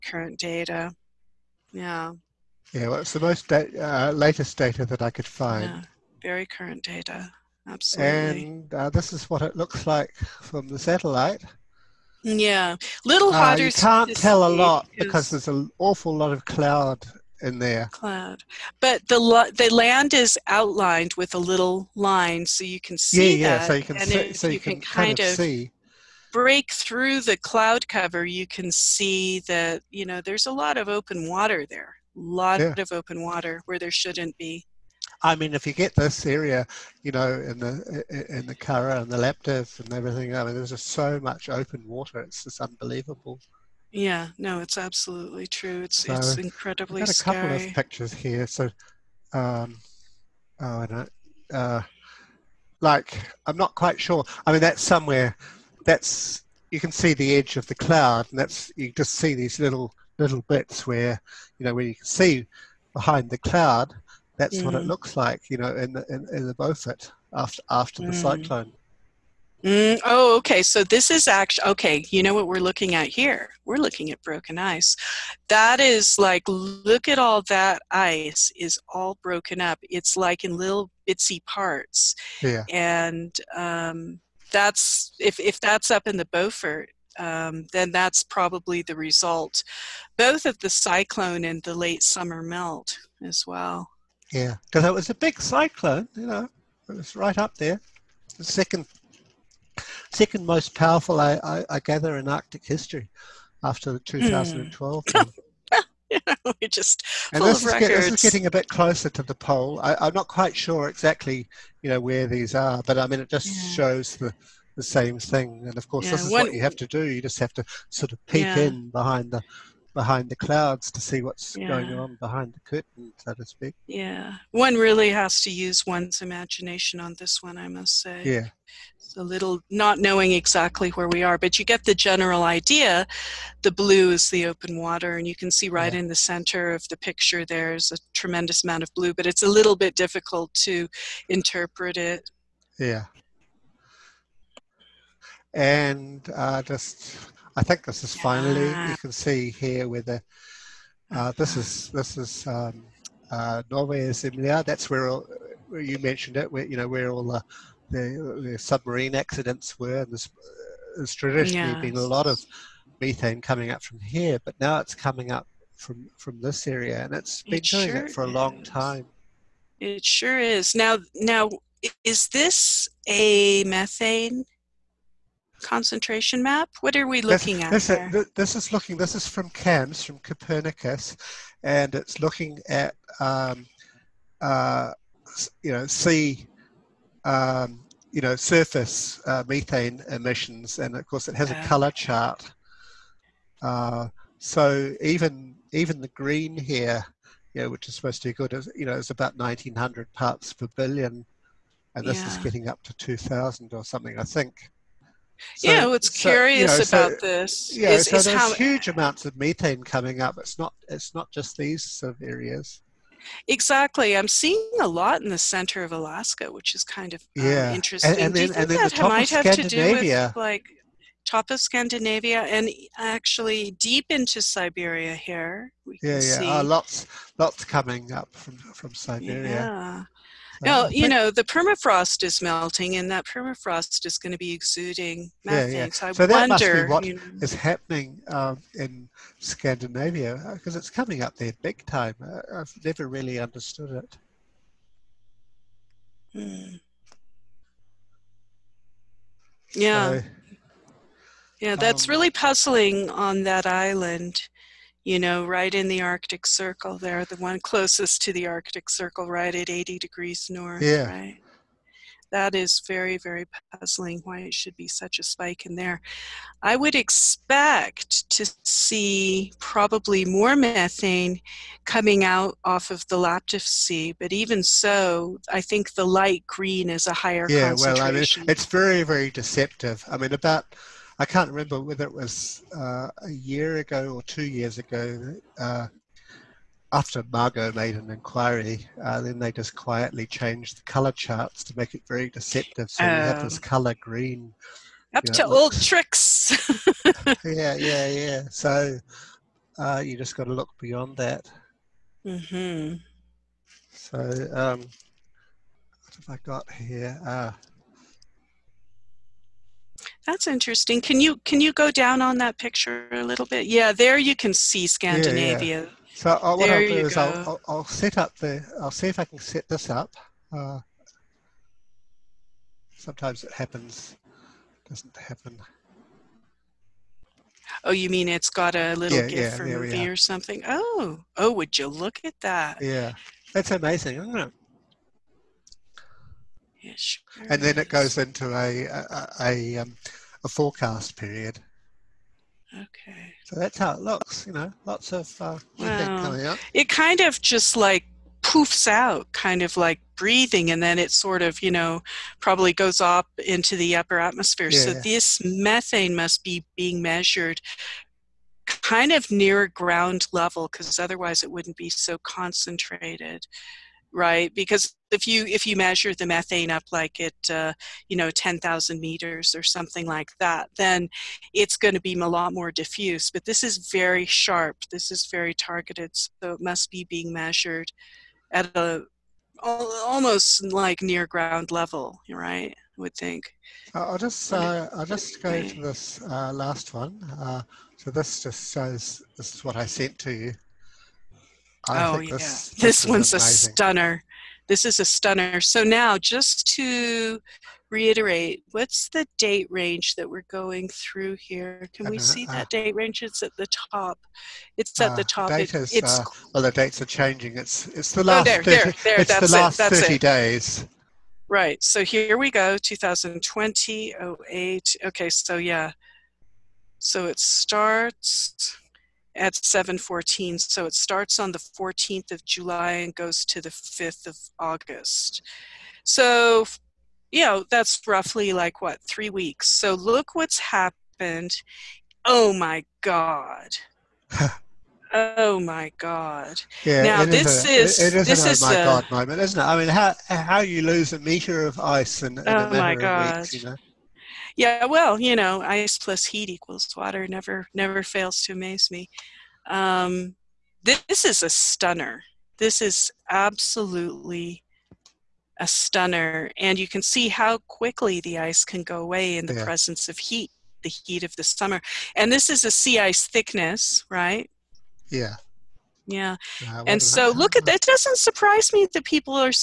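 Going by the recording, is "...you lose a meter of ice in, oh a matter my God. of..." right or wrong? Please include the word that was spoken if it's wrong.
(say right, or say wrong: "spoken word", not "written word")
right.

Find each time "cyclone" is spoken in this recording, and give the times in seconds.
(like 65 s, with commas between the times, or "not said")
68 s, 90 s, 95 s.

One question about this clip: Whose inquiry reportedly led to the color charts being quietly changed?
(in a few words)
Margot.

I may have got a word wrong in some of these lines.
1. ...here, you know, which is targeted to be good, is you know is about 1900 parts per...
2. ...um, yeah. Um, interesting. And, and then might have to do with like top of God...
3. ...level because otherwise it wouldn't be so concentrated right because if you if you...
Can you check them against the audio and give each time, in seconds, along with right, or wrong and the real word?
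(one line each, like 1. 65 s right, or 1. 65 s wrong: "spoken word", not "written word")
1. 196 s wrong: "supposed", not "targeted"
2. 217 s wrong: "Scandinavia", not "God"
3. 360 s right.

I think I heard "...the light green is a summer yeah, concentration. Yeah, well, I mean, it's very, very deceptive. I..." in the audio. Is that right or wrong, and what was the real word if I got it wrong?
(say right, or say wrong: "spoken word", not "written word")
wrong: "higher", not "summer".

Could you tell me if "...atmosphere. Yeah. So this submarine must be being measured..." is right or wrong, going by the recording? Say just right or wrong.
wrong.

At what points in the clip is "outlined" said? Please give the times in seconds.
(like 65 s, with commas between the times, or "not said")
20 s.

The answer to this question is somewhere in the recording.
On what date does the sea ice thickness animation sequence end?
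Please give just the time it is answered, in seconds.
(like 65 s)
423 s.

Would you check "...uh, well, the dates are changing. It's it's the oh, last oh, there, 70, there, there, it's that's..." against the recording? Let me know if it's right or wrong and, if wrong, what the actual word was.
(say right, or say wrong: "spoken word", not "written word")
wrong: "30", not "70".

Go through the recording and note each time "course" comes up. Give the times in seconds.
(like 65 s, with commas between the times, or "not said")
115 s, 191 s.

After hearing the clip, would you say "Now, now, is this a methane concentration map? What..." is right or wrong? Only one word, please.
right.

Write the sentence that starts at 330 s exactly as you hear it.
Oh, oh, would you look at that?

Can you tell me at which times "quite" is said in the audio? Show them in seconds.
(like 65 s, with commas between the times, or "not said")
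53 s, 110 s.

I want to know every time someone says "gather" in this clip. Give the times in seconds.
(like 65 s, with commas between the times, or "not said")
101 s.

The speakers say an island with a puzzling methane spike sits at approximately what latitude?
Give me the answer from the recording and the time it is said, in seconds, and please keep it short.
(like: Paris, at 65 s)
80 degrees north, at 259 s.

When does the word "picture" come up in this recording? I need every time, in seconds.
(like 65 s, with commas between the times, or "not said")
47 s, 136 s, 312 s.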